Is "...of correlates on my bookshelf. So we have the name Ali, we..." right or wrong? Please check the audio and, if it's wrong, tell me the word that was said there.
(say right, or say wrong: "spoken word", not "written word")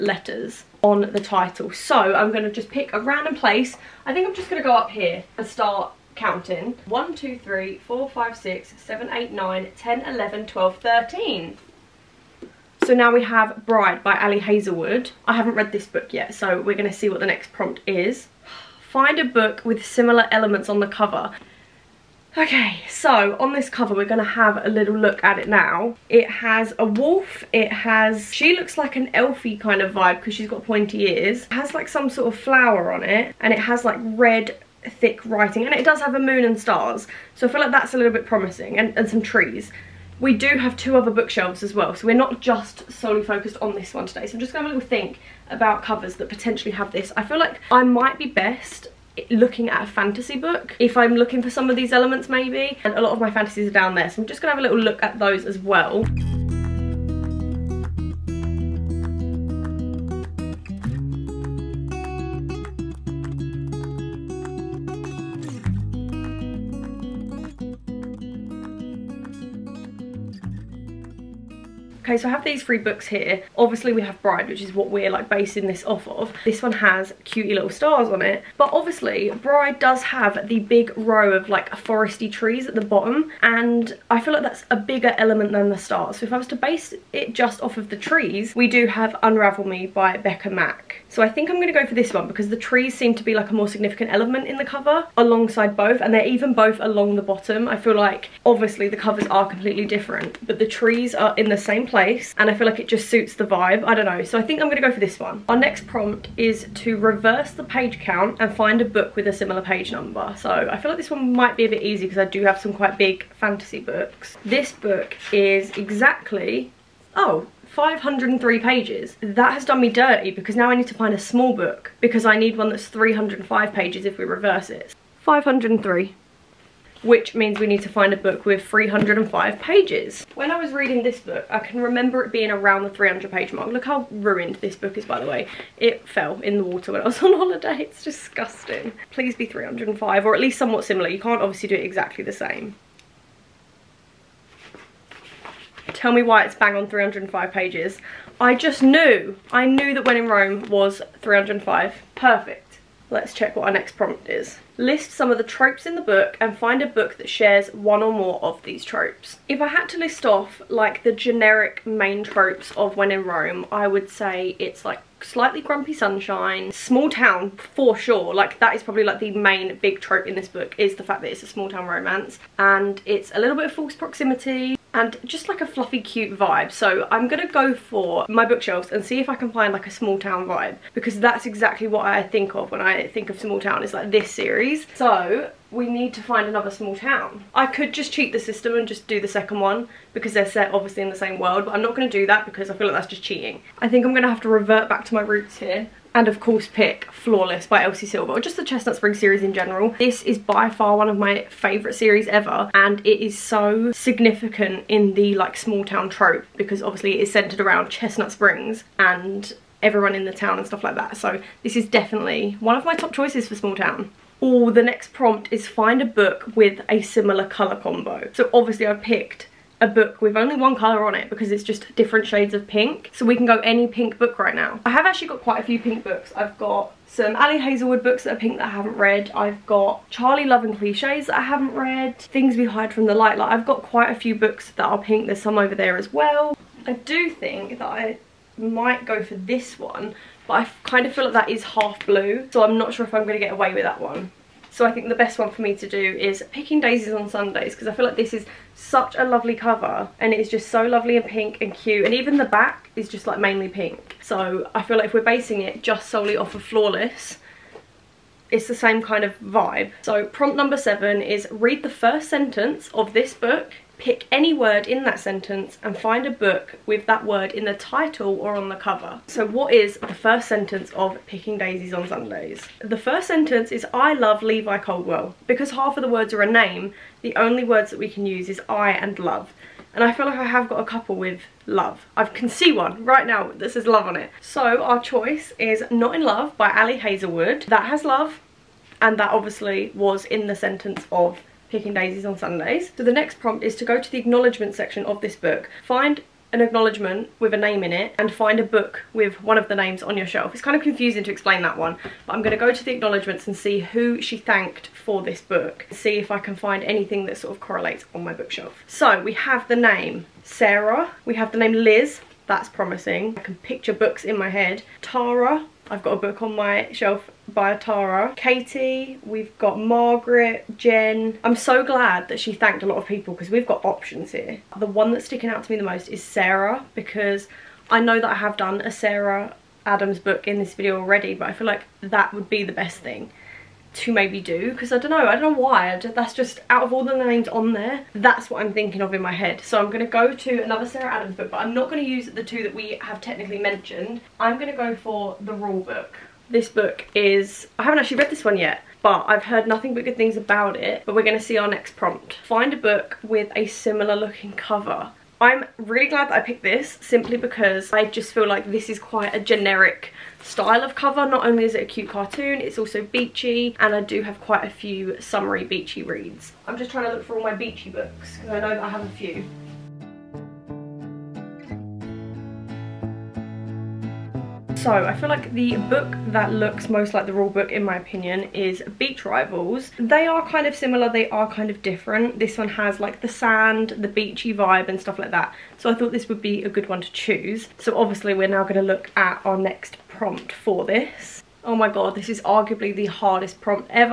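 wrong: "Sarah", not "Ali".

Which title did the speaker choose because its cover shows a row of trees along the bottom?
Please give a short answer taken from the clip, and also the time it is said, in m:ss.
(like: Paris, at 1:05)
Unravel Me, at 1:29.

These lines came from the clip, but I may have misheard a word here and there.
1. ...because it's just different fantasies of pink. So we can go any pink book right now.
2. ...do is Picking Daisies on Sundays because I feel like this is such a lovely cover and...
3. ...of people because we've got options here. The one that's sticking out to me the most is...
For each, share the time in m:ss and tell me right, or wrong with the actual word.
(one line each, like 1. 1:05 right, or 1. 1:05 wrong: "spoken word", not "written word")
1. 3:41 wrong: "shades", not "fantasies"
2. 4:05 right
3. 5:22 right.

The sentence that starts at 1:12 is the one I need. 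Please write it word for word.
Okay, so I have these three books here.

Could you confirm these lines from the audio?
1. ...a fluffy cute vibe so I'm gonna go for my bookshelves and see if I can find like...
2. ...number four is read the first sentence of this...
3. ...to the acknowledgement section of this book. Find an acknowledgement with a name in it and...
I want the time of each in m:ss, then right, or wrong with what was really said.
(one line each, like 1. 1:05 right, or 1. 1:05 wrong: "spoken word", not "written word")
1. 2:55 right
2. 4:20 wrong: "seven", not "four"
3. 4:53 right.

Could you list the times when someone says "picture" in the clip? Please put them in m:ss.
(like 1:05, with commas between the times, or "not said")
5:13.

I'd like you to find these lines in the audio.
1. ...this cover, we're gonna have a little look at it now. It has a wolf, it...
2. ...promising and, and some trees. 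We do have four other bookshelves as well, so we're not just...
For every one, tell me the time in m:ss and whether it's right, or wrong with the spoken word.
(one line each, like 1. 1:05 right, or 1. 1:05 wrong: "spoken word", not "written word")
1. 0:23 right
2. 0:38 wrong: "two", not "four".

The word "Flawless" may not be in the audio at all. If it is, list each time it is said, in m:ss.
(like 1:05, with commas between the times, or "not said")
3:17, 4:16.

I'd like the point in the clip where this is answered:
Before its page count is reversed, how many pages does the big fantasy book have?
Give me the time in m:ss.
1:57.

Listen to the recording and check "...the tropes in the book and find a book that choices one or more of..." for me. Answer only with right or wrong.
wrong.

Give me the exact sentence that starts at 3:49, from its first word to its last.
I've got Charlie Love and Cliches that I haven't read.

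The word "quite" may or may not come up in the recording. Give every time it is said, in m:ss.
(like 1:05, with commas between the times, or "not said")
1:52, 3:45, 3:53, 5:58, 6:04.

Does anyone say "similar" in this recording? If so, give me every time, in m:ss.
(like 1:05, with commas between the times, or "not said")
0:19, 1:49, 2:20, 3:37, 5:53, 6:20.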